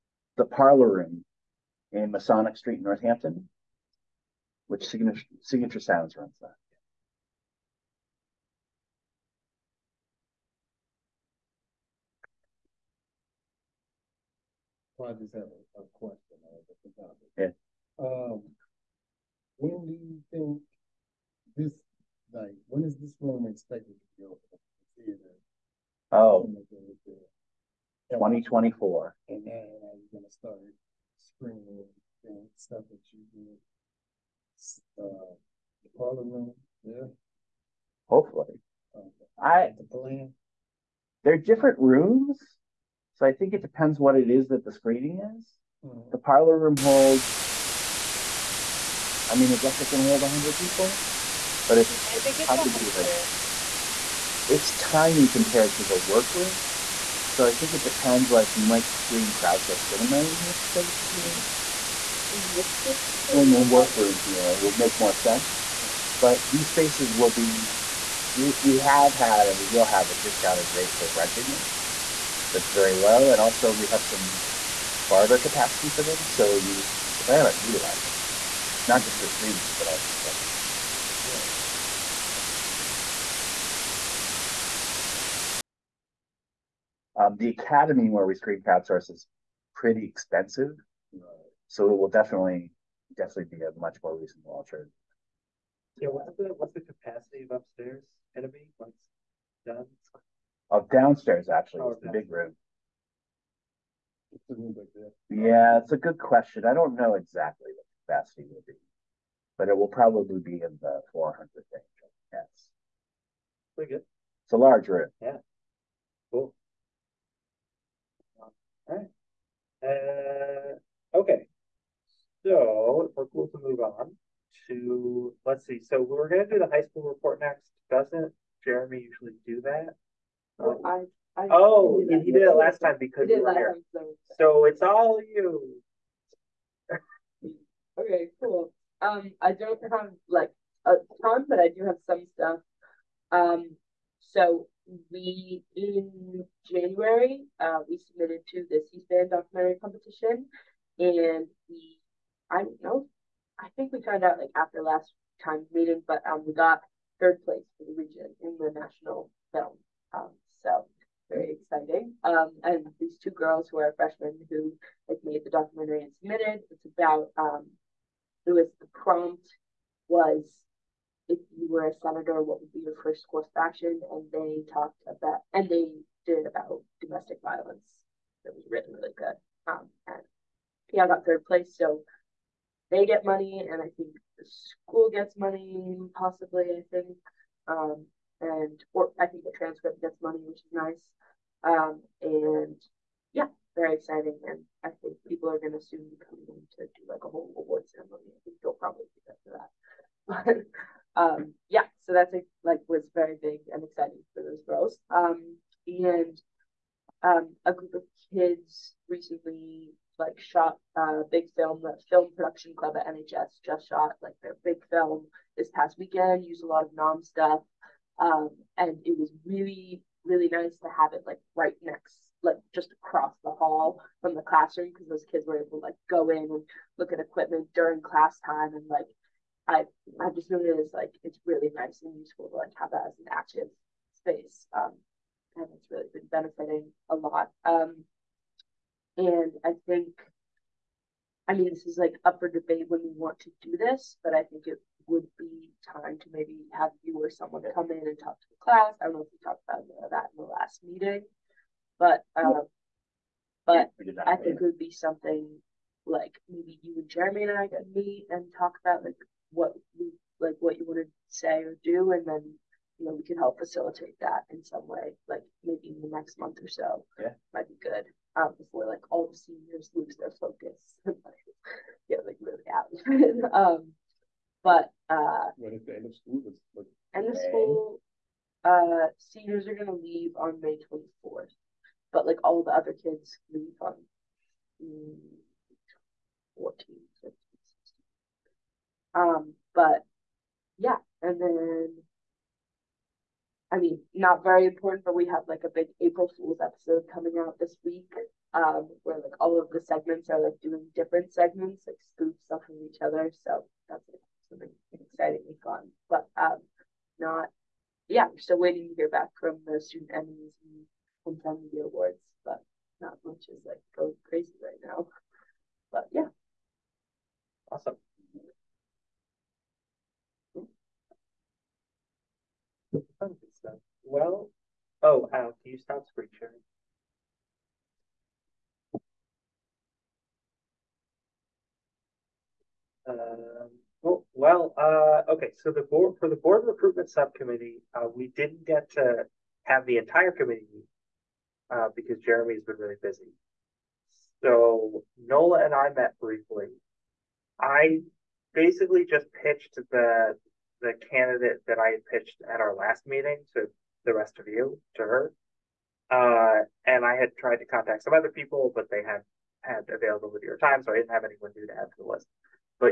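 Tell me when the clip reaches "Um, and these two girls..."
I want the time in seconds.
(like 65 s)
162 s.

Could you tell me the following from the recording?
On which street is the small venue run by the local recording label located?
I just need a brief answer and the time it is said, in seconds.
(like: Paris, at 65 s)
Masonic Street, at 2 s.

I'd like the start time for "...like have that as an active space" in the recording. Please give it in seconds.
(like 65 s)
232 s.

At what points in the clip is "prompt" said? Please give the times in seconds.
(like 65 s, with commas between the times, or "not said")
168 s.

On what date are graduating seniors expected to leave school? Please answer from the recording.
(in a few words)
May 24.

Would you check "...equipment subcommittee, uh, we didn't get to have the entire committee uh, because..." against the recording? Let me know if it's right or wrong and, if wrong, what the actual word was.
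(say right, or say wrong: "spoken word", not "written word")
wrong: "recruitment", not "equipment".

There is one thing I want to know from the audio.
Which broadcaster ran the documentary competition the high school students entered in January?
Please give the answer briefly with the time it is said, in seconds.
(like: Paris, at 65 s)
C-SPAN, at 148 s.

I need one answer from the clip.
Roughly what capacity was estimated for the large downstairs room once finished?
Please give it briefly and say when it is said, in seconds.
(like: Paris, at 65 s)
400, at 111 s.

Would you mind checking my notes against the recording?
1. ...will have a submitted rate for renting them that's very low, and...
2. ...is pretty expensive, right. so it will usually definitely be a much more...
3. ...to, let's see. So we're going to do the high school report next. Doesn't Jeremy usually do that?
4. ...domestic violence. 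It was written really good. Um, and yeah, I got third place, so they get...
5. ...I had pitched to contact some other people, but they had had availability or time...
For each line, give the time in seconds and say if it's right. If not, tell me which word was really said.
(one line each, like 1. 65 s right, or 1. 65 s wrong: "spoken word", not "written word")
1. 69 s wrong: "discounted", not "submitted"
2. 89 s wrong: "definitely", not "usually"
3. 124 s right
4. 176 s right
5. 357 s wrong: "tried", not "pitched".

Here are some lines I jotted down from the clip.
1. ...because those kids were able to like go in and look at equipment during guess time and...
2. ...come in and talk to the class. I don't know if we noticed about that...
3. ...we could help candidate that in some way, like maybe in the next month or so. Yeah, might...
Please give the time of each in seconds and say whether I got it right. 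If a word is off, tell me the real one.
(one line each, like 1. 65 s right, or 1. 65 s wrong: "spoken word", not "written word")
1. 224 s wrong: "class", not "guess"
2. 247 s wrong: "talked", not "noticed"
3. 263 s wrong: "facilitate", not "candidate".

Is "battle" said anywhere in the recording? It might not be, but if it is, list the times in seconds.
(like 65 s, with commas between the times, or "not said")
not said.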